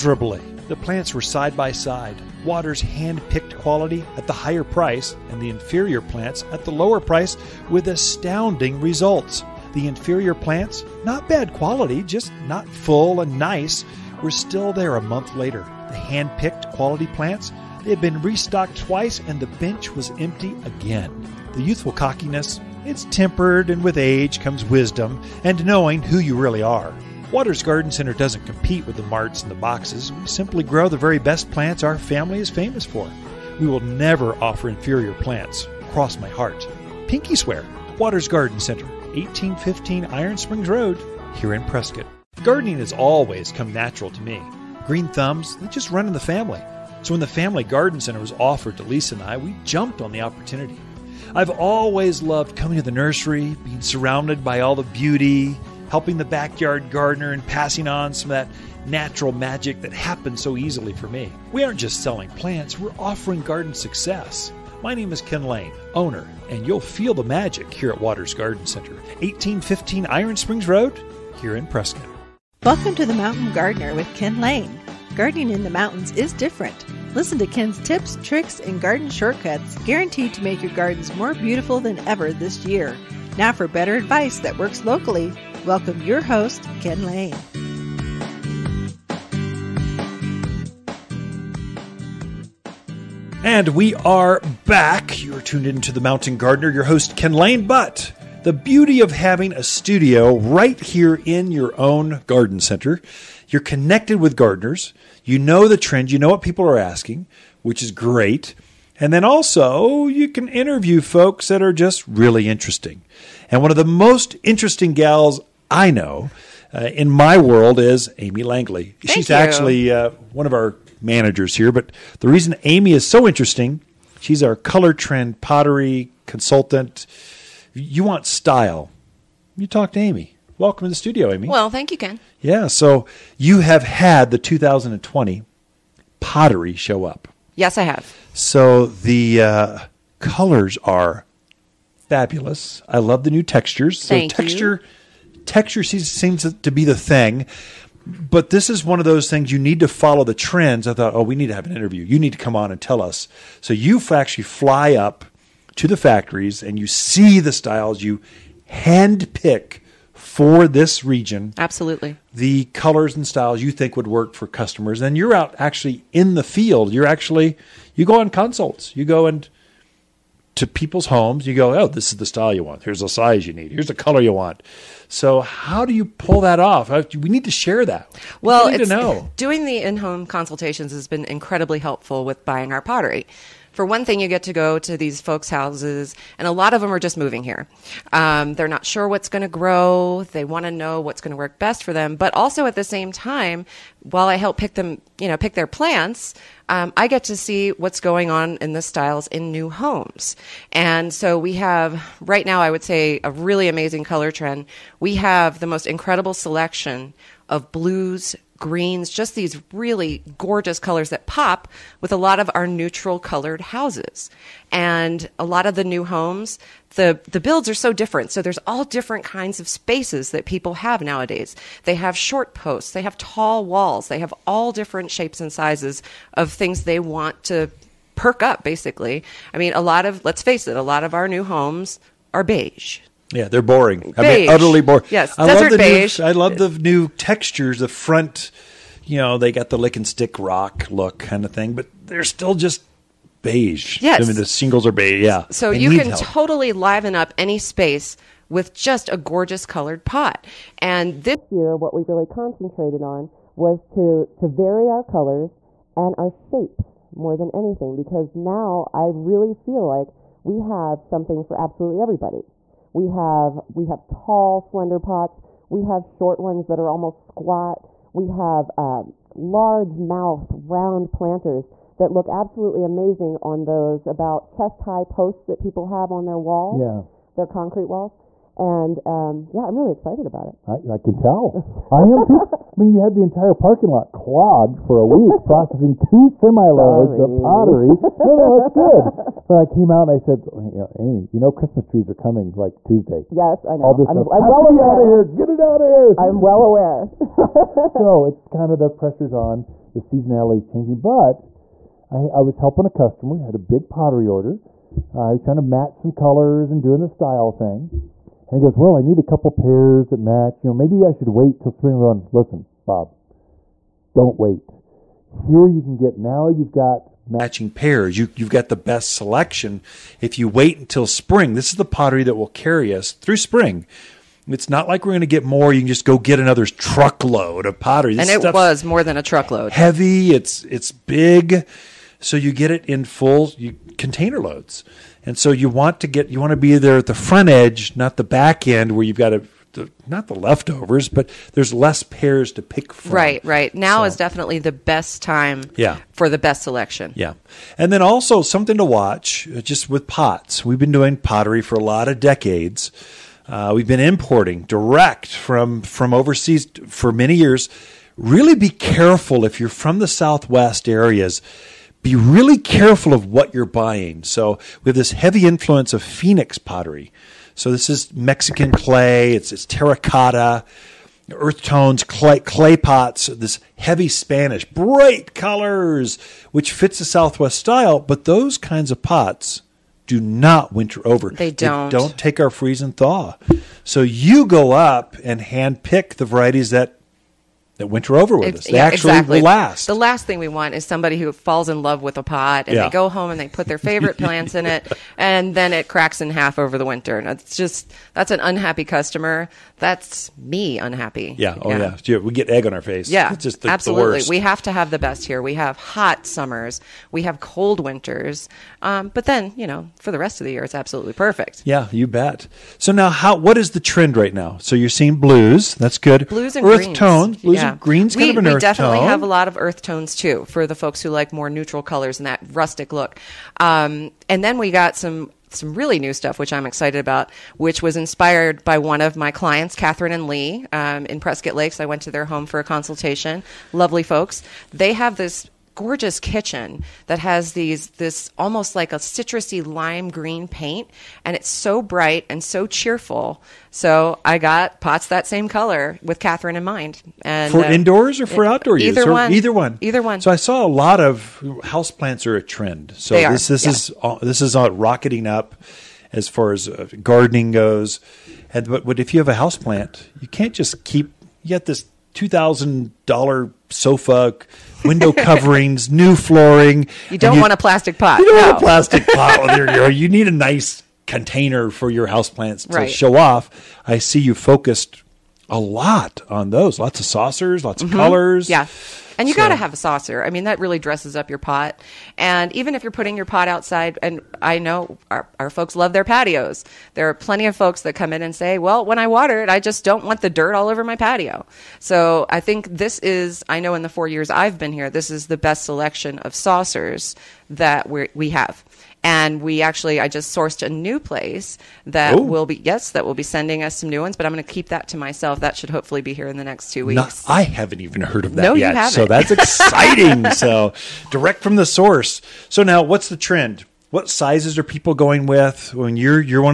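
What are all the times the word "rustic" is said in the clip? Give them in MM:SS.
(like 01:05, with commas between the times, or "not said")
07:02.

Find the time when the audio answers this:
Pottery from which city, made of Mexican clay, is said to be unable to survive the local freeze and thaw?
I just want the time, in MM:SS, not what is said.
06:06.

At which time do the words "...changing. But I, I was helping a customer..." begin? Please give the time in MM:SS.
05:00.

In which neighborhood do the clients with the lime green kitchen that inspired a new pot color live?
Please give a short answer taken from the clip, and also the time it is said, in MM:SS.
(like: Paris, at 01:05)
Prescott Lakes, at 07:11.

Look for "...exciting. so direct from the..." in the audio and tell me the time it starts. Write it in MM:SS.
08:29.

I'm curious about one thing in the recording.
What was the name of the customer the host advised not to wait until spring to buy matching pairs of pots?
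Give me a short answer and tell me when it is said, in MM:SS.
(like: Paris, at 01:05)
Bob, at 05:12.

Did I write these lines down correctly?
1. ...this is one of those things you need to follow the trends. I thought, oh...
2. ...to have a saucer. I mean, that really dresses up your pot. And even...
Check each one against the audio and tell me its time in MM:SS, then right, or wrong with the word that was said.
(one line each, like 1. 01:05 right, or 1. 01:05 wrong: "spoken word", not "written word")
1. 02:28 right
2. 07:59 right.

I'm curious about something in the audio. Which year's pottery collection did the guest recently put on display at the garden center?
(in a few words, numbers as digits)
2020.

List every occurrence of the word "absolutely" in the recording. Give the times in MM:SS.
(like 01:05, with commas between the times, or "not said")
02:41, 04:21, 04:32, 06:43, 06:50.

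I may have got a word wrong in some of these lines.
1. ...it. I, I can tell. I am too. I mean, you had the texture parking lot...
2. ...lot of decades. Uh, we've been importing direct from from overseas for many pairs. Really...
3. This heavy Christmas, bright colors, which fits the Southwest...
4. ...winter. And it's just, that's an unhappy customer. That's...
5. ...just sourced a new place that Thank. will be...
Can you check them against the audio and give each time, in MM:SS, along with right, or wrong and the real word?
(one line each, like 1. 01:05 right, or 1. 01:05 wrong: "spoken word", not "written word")
1. 04:40 wrong: "entire", not "texture"
2. 05:51 wrong: "years", not "pairs"
3. 06:13 wrong: "Spanish", not "Christmas"
4. 06:36 right
5. 08:20 wrong: "Ooh", not "Thank".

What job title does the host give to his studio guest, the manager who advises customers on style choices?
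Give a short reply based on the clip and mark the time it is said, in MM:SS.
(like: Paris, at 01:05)
color trend pottery consultant, at 02:04.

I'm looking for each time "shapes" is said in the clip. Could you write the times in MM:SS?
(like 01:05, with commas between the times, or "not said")
03:45, 04:16.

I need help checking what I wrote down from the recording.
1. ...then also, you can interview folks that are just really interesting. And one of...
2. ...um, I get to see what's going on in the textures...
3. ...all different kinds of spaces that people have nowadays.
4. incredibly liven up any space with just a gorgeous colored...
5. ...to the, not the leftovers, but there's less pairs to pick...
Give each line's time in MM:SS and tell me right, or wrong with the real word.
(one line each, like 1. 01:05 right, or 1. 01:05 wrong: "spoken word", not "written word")
1. 01:49 right
2. 03:16 wrong: "styles", not "textures"
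3. 03:38 right
4. 04:06 wrong: "totally", not "incredibly"
5. 05:39 right.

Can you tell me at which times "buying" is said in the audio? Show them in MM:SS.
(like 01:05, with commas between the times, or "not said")
03:02, 06:03.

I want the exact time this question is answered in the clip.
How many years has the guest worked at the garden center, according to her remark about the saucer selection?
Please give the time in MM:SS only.
08:13.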